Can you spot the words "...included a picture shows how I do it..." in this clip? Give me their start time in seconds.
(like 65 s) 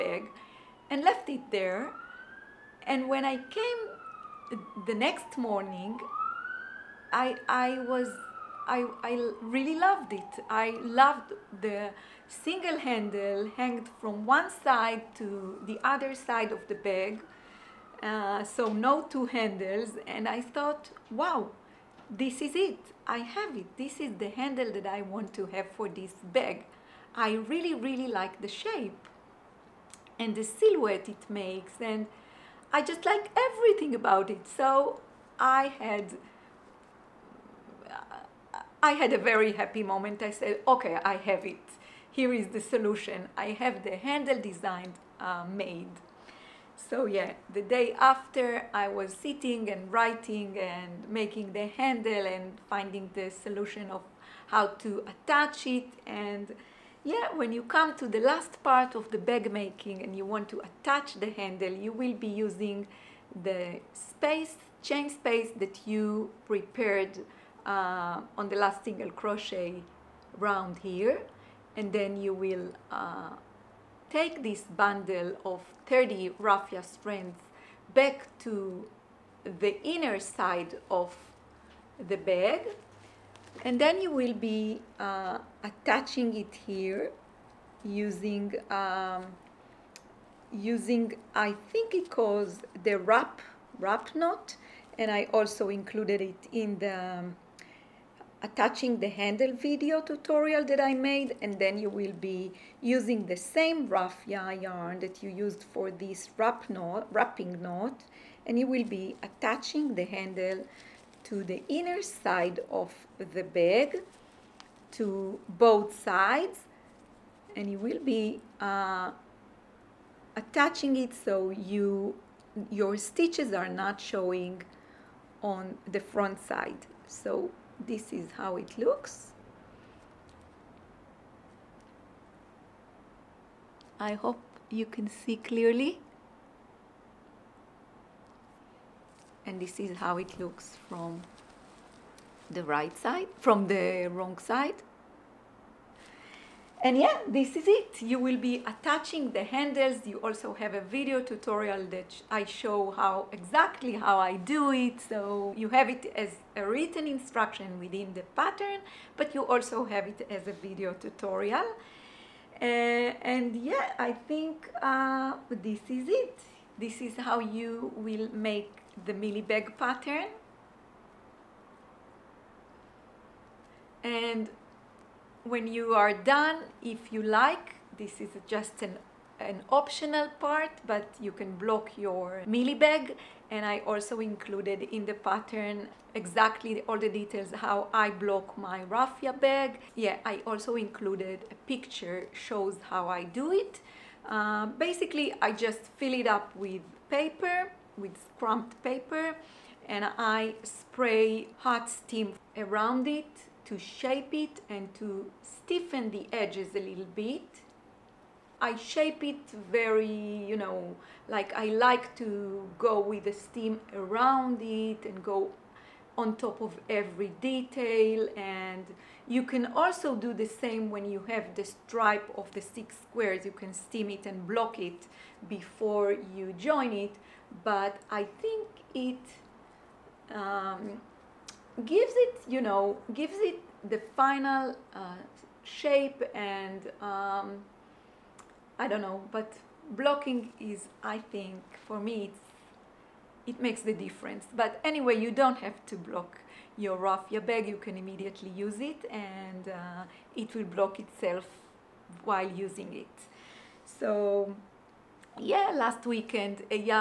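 190 s.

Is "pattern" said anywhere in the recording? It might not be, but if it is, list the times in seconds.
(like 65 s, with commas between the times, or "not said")
158 s, 169 s, 185 s.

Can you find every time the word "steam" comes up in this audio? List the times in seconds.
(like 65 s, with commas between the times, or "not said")
201 s, 213 s, 223 s.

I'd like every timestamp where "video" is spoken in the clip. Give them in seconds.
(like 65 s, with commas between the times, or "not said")
99 s, 150 s, 160 s.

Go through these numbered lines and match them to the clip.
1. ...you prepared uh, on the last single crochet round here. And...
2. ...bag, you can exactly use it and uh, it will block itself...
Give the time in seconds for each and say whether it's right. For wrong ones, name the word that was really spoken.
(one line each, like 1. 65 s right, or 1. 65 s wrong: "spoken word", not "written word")
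1. 65 s right
2. 247 s wrong: "immediately", not "exactly".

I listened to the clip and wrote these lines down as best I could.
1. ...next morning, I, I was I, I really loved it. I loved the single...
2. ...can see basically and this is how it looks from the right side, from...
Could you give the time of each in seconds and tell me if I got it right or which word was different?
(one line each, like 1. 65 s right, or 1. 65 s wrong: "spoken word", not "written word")
1. 4 s right
2. 134 s wrong: "clearly", not "basically".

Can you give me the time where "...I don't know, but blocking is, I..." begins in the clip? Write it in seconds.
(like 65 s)
238 s.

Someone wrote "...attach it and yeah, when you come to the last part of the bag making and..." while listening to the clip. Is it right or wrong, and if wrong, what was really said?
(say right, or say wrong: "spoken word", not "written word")
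right.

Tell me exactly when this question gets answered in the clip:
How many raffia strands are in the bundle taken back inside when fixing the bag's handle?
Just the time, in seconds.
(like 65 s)
75 s.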